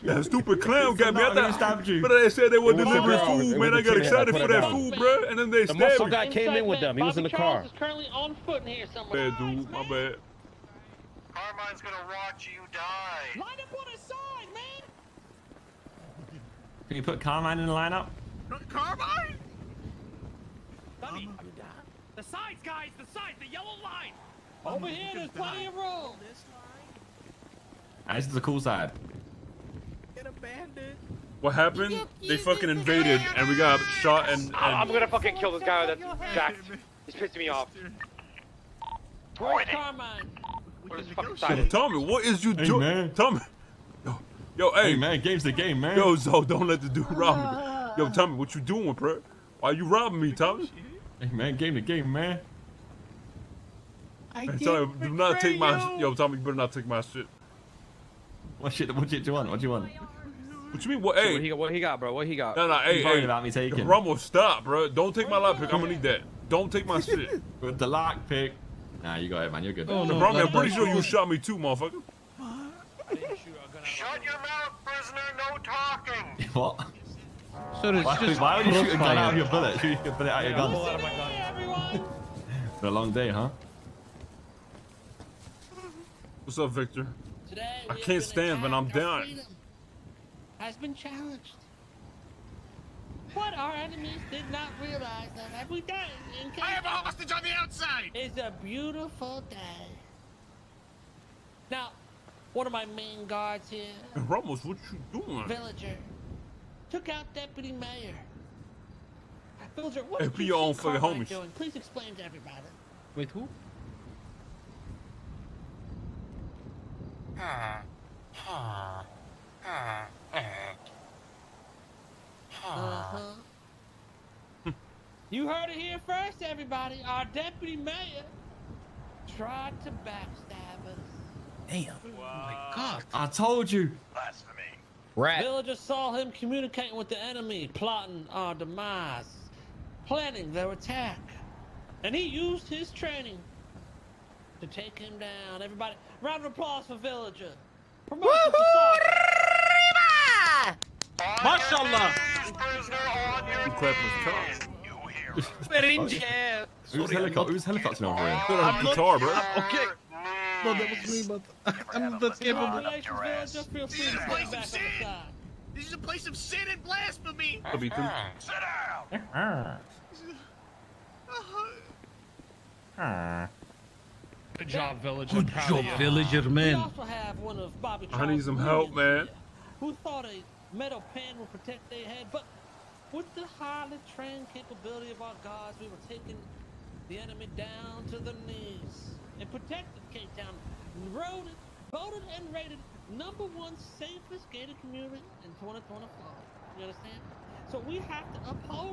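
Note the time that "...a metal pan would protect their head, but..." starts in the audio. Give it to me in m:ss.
3:00.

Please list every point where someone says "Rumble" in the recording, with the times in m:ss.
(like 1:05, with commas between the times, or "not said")
1:03, 1:10.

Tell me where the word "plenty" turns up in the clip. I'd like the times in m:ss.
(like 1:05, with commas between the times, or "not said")
0:25.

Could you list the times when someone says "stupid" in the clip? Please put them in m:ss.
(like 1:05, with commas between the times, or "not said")
0:00.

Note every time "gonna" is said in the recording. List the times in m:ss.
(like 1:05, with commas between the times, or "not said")
0:11, 0:34, 1:05.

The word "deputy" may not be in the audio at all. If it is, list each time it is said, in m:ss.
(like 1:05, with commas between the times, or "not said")
1:47, 2:07.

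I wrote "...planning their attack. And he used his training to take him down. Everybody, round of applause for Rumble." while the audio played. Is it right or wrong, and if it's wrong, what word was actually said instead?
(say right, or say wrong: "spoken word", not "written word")
wrong: "Villager", not "Rumble".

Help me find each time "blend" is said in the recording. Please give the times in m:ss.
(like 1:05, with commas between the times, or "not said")
not said.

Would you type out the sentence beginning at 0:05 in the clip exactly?
And then they the muscle guy came in with them.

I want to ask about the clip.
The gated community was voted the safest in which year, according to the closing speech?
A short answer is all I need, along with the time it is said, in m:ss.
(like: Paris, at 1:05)
2024, at 3:15.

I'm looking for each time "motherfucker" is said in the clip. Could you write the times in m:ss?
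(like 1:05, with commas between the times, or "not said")
1:11.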